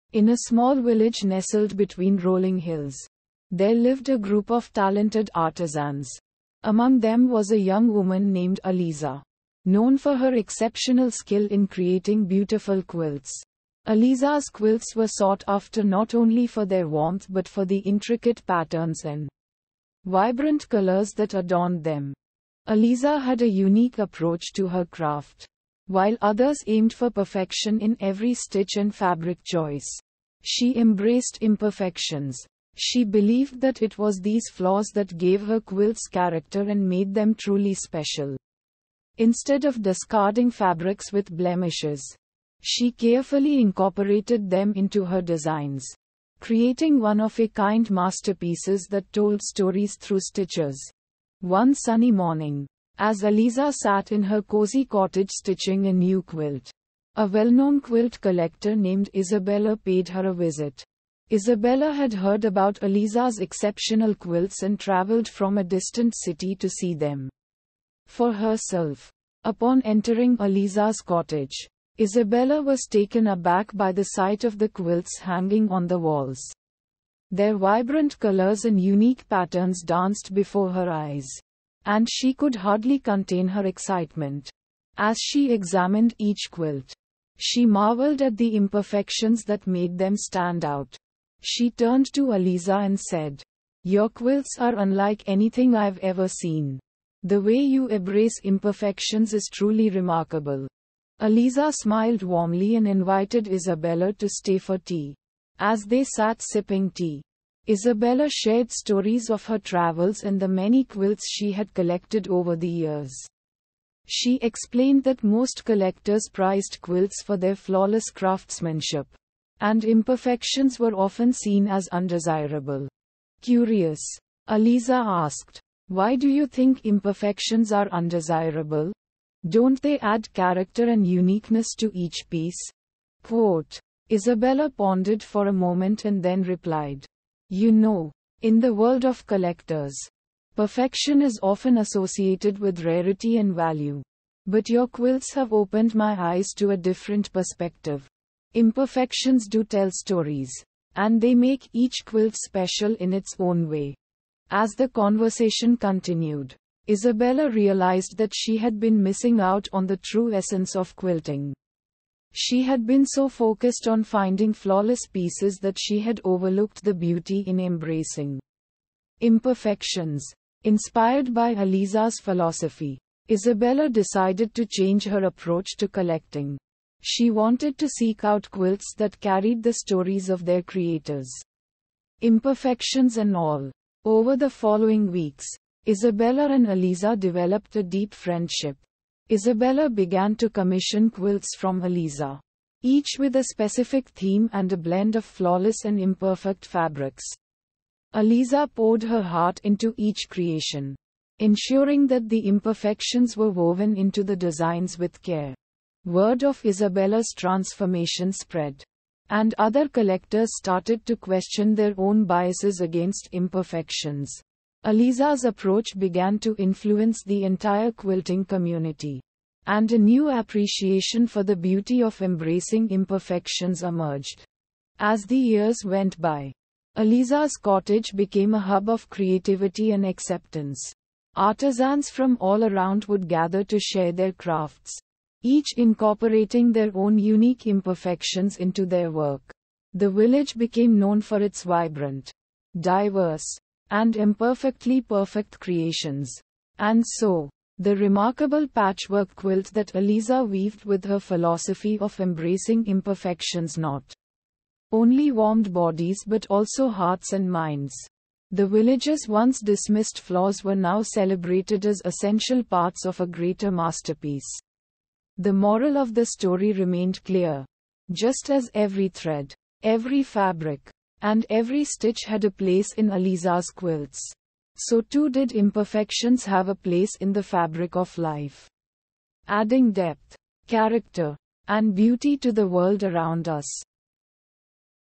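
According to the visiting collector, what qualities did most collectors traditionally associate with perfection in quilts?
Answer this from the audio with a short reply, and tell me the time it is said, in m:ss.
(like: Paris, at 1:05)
Rarity and value, at 2:22.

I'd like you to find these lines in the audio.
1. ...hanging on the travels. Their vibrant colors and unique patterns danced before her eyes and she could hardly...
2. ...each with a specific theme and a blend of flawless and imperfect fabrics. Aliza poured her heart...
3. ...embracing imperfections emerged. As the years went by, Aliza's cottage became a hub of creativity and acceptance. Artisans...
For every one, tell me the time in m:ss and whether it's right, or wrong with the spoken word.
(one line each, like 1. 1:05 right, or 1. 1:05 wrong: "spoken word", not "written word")
1. 1:15 wrong: "walls", not "travels"
2. 3:12 right
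3. 3:42 right.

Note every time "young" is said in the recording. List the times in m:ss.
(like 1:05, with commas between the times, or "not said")
0:07.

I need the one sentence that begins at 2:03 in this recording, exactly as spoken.
Curious, Aliza asked, Why do you think imperfections are undesirable?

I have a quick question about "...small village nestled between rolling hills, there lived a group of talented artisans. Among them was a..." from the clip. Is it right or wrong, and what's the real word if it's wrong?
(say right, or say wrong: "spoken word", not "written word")
right.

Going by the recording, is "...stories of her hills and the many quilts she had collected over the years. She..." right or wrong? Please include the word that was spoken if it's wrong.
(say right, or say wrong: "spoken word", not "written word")
wrong: "travels", not "hills".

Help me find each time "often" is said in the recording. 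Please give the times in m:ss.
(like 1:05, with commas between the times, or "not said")
2:00, 2:21.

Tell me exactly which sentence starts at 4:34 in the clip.
So too did imperfections have a place in the fabric of life.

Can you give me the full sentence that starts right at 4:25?
The moral of the story remained clear.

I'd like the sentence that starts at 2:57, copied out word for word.
She wanted to seek out quilts that carried the stories of their creators.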